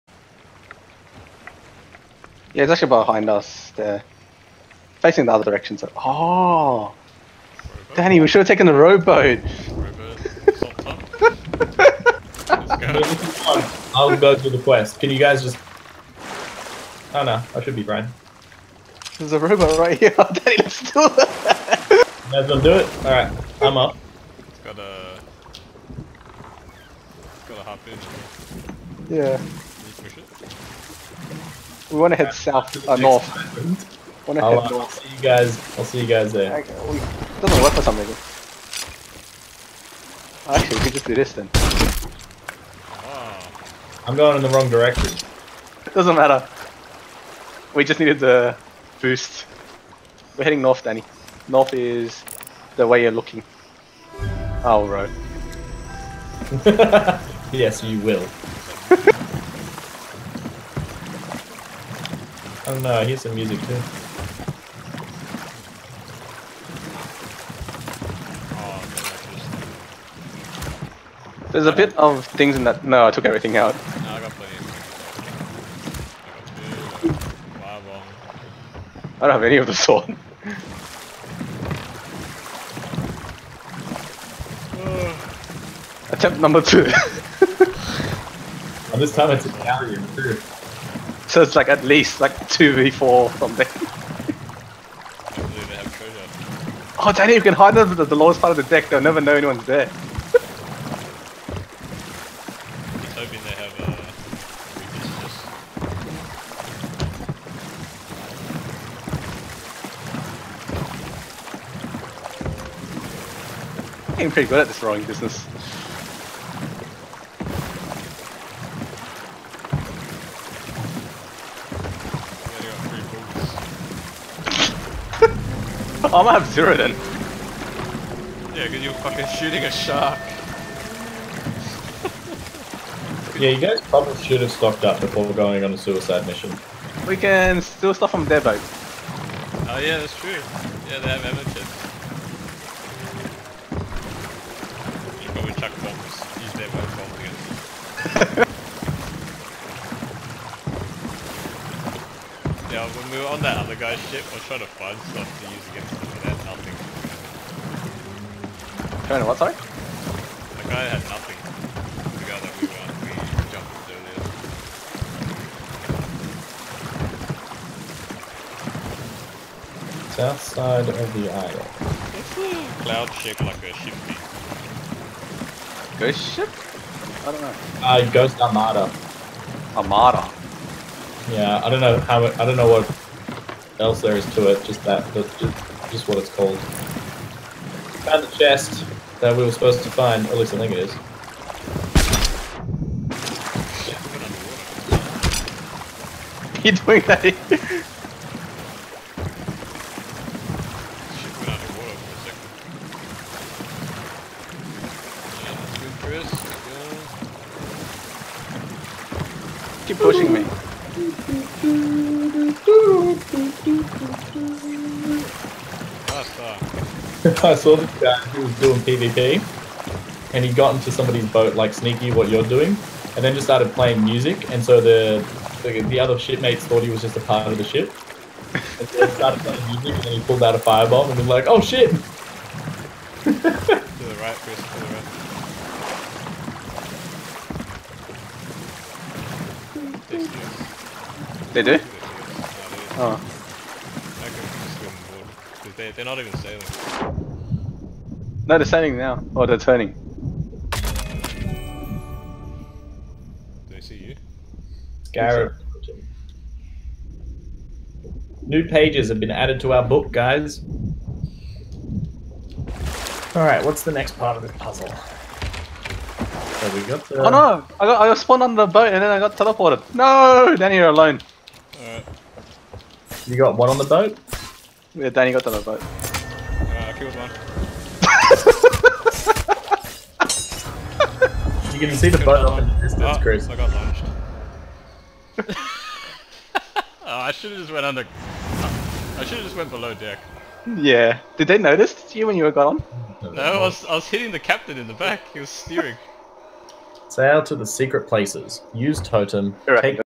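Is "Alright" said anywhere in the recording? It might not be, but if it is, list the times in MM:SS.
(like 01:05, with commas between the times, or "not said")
00:23, 04:23, 04:31.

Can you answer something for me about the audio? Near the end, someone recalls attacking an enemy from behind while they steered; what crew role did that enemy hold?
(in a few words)
captain.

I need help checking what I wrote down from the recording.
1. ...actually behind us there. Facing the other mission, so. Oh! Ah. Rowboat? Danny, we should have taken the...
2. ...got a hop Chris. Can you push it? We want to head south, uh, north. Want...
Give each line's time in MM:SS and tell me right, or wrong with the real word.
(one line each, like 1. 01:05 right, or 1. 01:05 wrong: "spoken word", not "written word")
1. 00:02 wrong: "direction", not "mission"
2. 00:27 wrong: "Yeah", not "Chris".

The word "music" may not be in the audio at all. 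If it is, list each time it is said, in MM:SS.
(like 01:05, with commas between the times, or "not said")
01:03, 03:44, 03:49.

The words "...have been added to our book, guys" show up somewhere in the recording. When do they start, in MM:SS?
04:19.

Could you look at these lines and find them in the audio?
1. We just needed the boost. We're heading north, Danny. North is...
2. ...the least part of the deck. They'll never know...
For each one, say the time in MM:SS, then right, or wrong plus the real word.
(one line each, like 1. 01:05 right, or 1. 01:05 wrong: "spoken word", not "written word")
1. 00:47 right
2. 01:38 wrong: "lowest", not "least".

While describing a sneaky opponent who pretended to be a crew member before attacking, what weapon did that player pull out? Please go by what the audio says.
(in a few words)
a firebomb.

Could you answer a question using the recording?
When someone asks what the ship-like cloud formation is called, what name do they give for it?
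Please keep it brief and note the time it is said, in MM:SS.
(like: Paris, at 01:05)
Ghost Armada, at 02:58.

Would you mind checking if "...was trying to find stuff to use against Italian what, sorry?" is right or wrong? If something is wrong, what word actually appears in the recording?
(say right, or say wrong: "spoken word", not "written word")
wrong: "Coming", not "Italian".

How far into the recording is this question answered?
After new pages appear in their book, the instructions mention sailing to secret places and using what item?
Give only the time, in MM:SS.
04:58.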